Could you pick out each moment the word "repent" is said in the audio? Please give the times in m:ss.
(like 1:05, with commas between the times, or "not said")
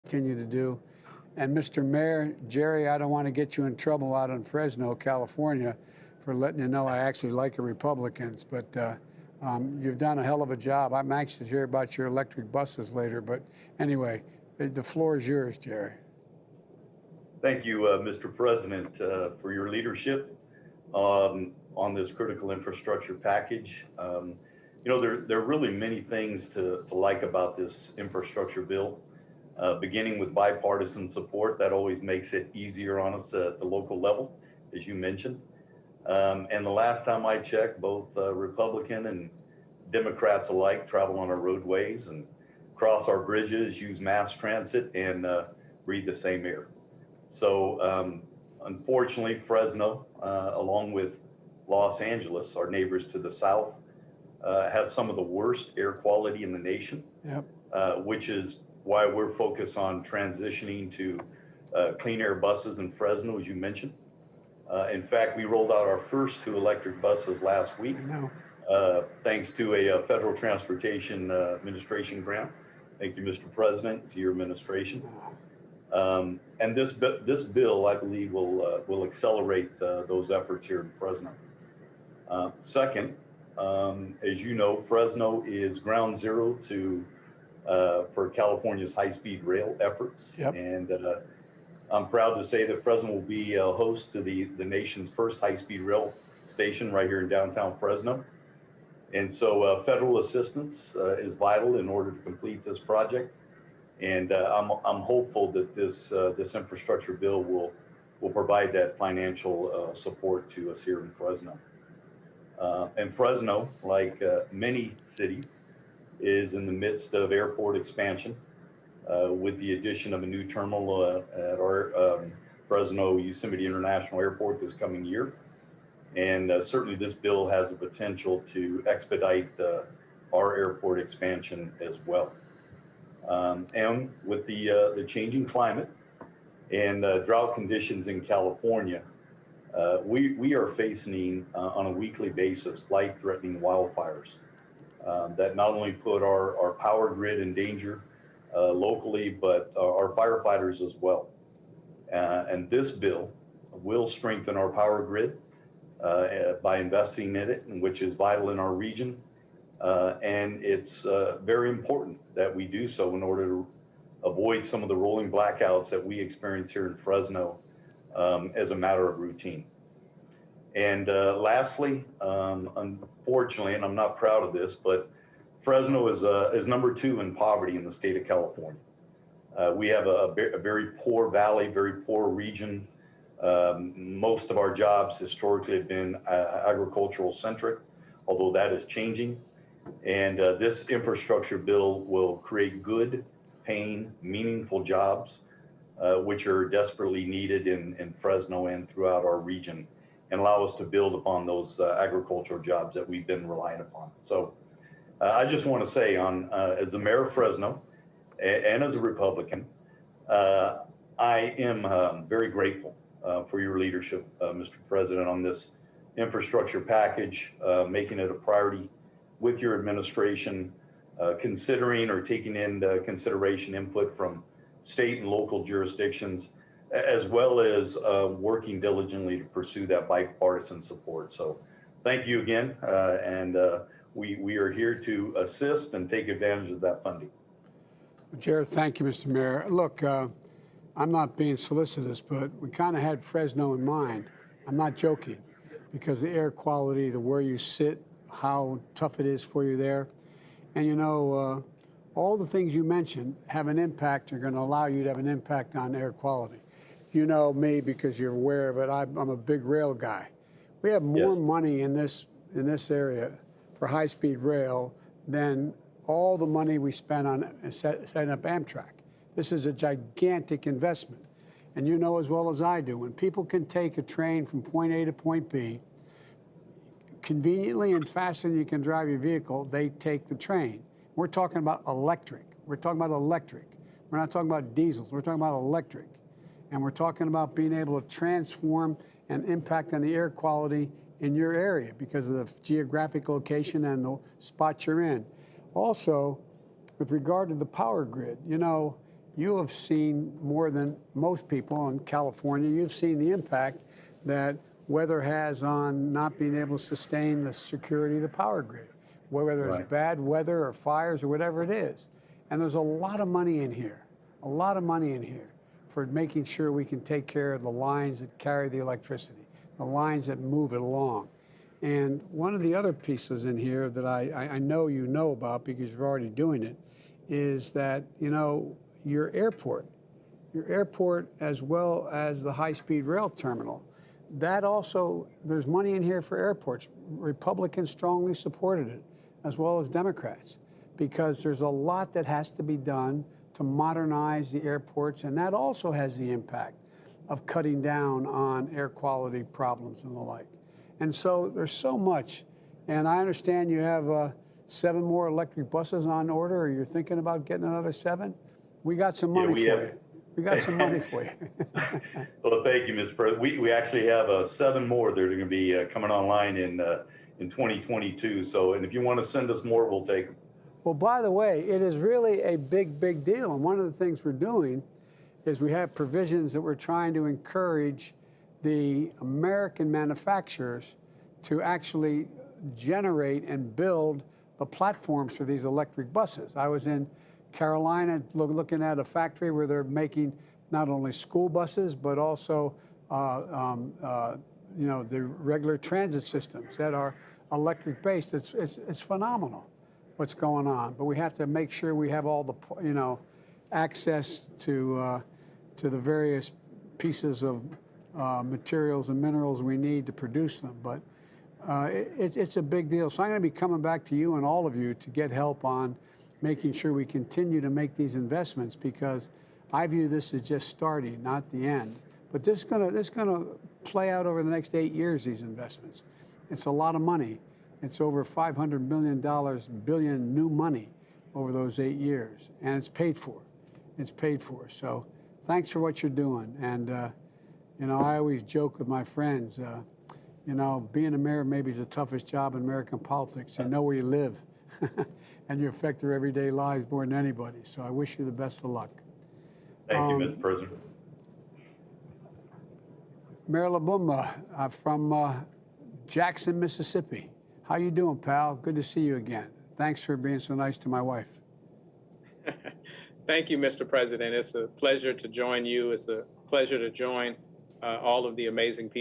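not said.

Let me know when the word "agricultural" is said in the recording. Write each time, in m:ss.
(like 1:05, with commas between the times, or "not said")
3:06, 3:22.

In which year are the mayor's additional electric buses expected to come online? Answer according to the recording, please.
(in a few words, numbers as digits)
2022.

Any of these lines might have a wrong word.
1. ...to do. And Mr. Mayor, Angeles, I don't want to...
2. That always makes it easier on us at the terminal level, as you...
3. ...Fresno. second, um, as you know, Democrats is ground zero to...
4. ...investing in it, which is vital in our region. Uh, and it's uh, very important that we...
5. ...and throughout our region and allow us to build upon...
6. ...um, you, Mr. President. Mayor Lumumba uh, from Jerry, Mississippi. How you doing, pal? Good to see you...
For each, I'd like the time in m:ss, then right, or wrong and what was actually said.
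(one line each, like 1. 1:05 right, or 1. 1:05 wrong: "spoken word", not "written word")
1. 0:00 wrong: "Jerry", not "Angeles"
2. 0:31 wrong: "local", not "terminal"
3. 1:20 wrong: "Fresno", not "Democrats"
4. 2:36 right
5. 3:18 right
6. 7:29 wrong: "Jackson", not "Jerry".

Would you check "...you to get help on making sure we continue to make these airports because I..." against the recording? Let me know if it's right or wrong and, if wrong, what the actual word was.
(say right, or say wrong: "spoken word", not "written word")
wrong: "investments", not "airports".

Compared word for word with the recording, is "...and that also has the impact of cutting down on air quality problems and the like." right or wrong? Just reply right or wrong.
right.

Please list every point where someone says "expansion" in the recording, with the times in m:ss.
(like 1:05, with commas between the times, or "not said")
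1:57, 2:10.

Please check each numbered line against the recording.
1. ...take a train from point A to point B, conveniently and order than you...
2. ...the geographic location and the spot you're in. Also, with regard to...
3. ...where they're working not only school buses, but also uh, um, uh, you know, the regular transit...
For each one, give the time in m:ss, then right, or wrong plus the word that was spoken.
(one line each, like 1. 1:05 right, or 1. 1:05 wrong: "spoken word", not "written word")
1. 4:33 wrong: "faster", not "order"
2. 4:52 right
3. 6:29 wrong: "making", not "working".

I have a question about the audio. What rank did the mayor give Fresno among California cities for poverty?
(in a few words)
Number 2.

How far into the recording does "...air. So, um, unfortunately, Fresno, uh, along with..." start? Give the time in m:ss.
0:46.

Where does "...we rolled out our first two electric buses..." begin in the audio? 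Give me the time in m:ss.
1:05.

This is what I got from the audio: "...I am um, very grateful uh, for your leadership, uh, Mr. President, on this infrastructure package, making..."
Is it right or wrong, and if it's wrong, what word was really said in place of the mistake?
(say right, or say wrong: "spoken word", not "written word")
right.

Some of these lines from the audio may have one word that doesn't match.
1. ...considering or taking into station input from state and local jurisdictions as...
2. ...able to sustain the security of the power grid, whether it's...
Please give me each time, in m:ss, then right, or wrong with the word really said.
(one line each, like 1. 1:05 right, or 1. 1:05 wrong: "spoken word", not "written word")
1. 3:41 wrong: "consideration", not "station"
2. 5:06 right.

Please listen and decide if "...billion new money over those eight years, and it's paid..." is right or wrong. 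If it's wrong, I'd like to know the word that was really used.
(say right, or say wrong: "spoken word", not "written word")
right.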